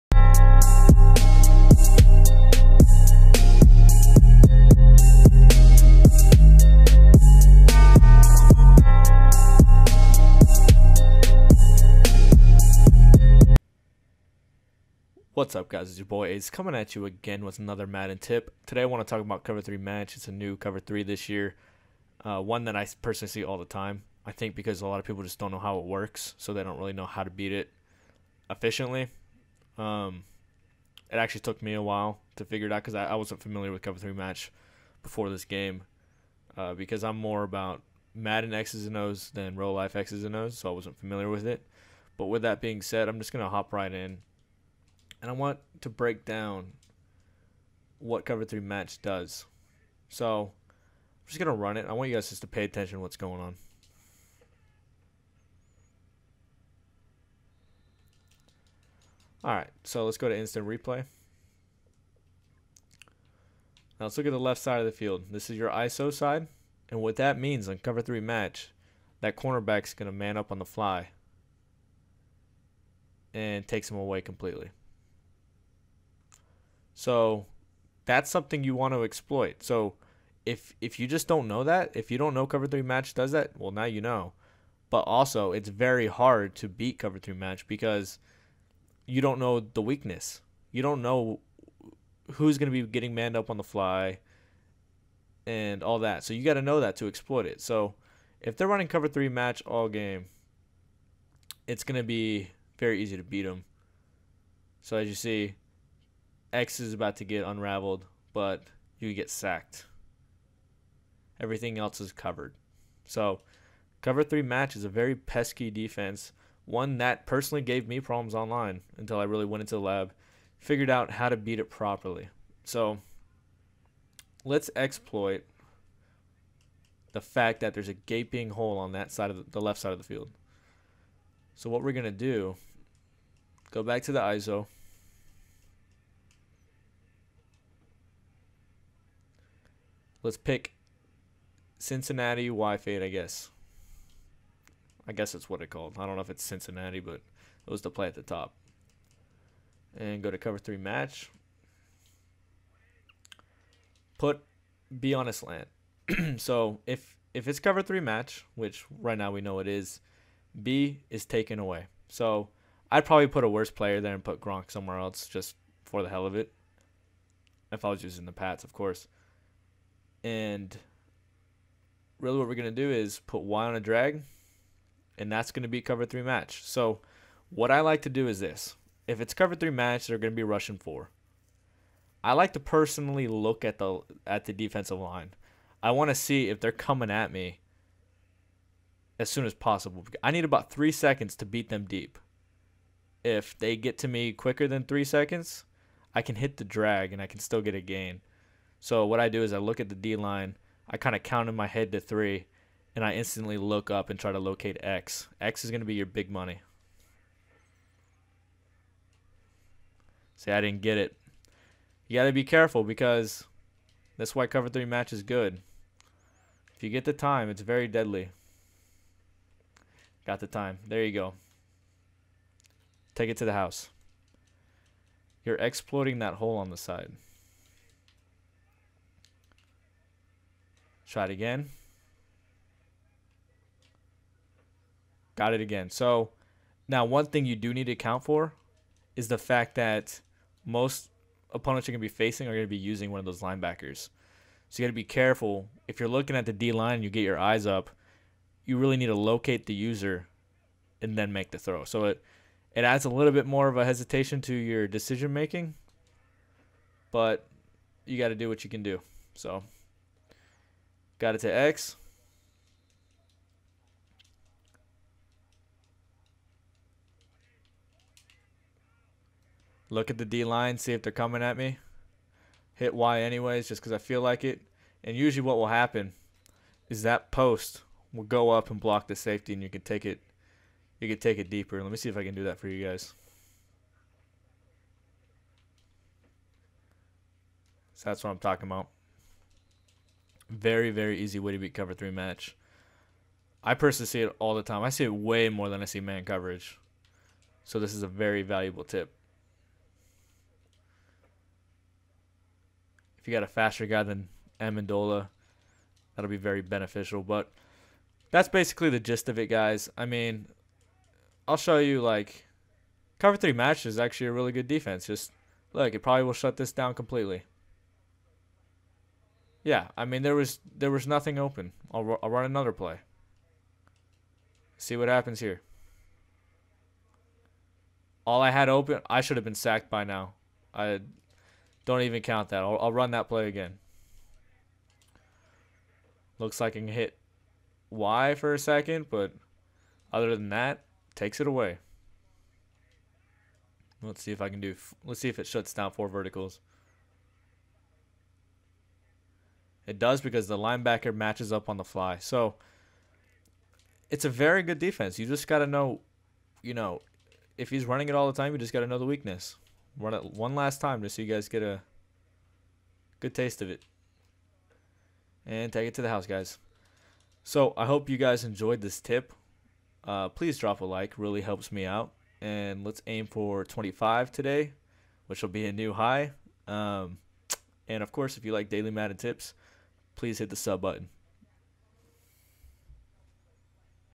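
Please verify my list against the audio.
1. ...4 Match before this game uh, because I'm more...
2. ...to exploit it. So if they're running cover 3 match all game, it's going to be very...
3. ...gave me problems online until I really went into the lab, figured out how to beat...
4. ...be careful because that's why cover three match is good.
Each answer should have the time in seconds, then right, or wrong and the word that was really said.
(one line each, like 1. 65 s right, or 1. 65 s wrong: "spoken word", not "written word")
1. 33 s wrong: "3", not "4"
2. 96 s right
3. 117 s right
4. 212 s right.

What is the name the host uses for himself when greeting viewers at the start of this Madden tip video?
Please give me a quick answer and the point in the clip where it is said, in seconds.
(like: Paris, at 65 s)
Ace, at 16 s.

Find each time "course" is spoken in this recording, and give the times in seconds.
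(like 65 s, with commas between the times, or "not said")
168 s, 378 s.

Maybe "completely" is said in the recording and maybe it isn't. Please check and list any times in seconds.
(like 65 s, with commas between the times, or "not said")
74 s, 316 s.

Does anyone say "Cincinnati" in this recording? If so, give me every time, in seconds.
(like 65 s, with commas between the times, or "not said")
141 s, 146 s.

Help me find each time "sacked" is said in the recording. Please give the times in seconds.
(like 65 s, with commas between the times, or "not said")
109 s, 329 s.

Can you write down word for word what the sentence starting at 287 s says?
So that's what I'm talking about.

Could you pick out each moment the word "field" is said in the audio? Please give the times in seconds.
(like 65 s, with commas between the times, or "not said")
64 s, 130 s.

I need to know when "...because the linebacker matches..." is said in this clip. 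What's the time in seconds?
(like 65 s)
350 s.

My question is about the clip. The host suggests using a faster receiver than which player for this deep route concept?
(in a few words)
Amendola.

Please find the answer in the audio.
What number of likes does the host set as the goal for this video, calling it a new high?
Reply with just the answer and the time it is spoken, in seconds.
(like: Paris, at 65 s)
25, at 373 s.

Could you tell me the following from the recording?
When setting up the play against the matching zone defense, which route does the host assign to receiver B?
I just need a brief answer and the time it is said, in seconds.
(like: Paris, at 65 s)
Slant, at 155 s.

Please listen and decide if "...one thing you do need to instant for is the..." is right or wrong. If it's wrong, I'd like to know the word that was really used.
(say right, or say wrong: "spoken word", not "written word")
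wrong: "account", not "instant".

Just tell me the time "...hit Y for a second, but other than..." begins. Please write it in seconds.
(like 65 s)
336 s.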